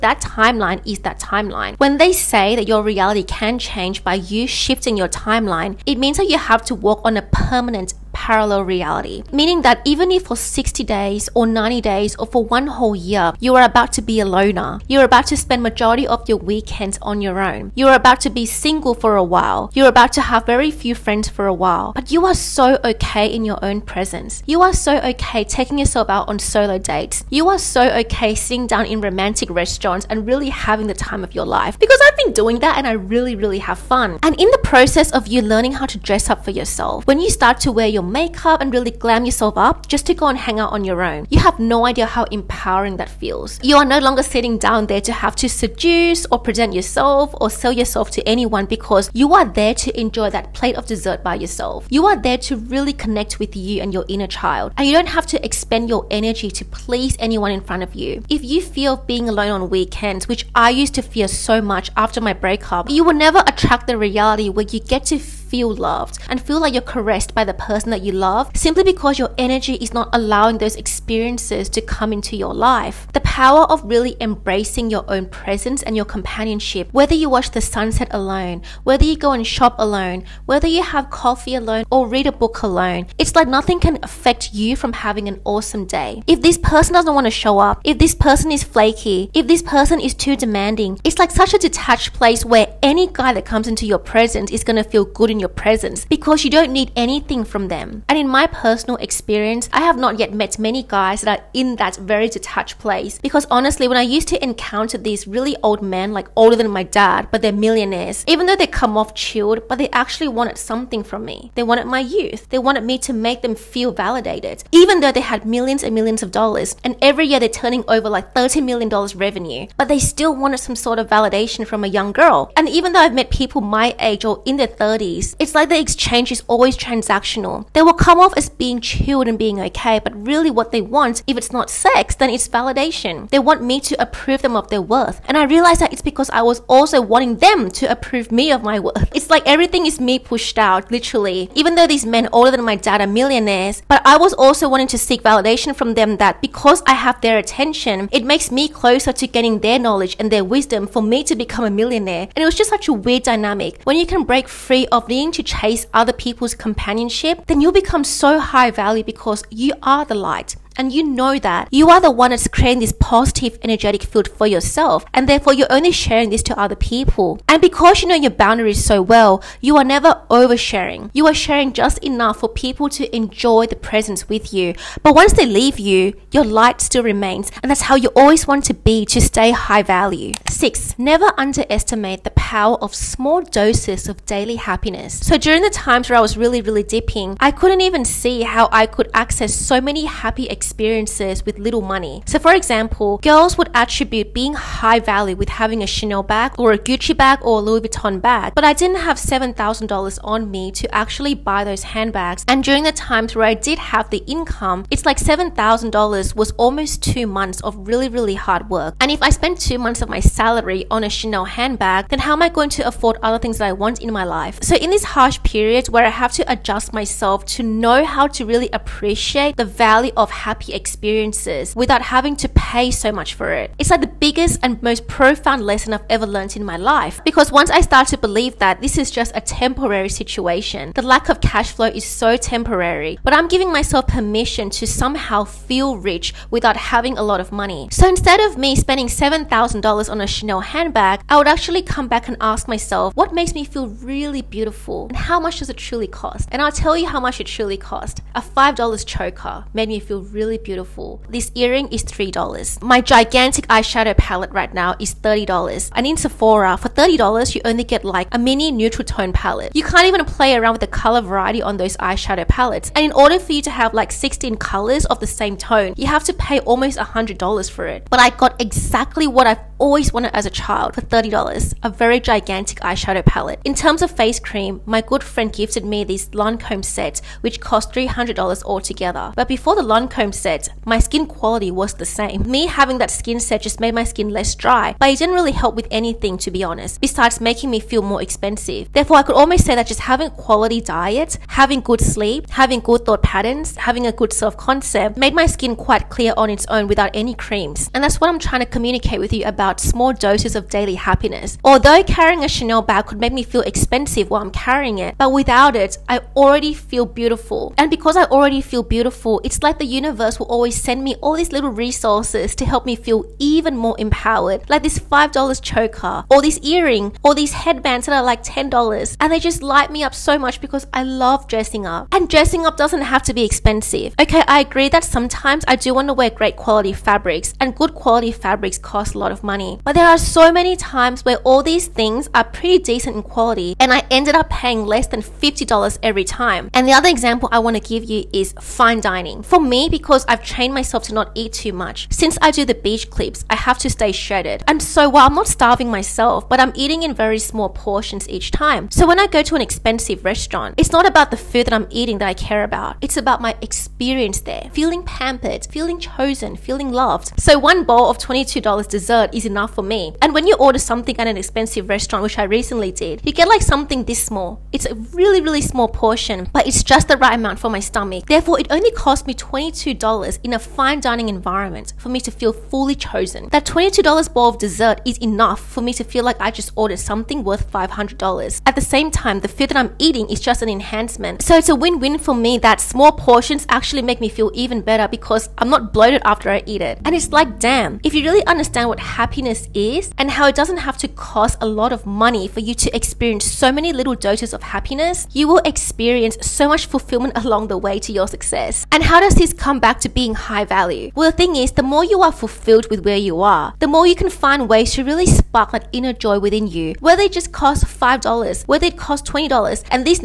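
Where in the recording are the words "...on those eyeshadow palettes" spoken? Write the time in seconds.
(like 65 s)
261 s.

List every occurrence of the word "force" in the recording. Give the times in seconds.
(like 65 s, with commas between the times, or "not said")
not said.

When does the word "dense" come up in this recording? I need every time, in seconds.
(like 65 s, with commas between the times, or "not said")
not said.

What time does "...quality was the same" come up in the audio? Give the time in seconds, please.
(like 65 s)
281 s.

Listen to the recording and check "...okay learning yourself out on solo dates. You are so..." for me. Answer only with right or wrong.
wrong.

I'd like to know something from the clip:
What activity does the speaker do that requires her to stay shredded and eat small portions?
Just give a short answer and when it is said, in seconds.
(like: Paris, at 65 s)
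beach clips, at 342 s.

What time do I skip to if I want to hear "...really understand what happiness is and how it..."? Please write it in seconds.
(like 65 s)
388 s.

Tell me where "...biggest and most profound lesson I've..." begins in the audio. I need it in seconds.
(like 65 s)
224 s.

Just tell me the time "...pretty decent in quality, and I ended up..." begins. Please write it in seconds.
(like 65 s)
332 s.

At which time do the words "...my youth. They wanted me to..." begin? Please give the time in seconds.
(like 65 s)
111 s.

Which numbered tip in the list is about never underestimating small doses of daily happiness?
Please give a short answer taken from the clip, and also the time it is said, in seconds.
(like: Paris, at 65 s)
6, at 180 s.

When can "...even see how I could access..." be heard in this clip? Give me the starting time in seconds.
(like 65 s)
187 s.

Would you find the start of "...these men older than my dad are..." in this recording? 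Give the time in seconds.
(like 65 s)
141 s.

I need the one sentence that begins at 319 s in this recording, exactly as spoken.
And they just light me up so much because I love dressing up.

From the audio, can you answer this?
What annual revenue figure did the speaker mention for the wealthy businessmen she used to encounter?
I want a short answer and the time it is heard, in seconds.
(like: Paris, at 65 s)
$30 million, at 118 s.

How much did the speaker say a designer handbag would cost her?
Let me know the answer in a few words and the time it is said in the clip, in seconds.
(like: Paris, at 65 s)
$7,000, at 199 s.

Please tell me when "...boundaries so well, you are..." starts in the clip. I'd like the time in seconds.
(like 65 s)
168 s.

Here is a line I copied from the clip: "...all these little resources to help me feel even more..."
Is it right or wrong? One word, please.
right.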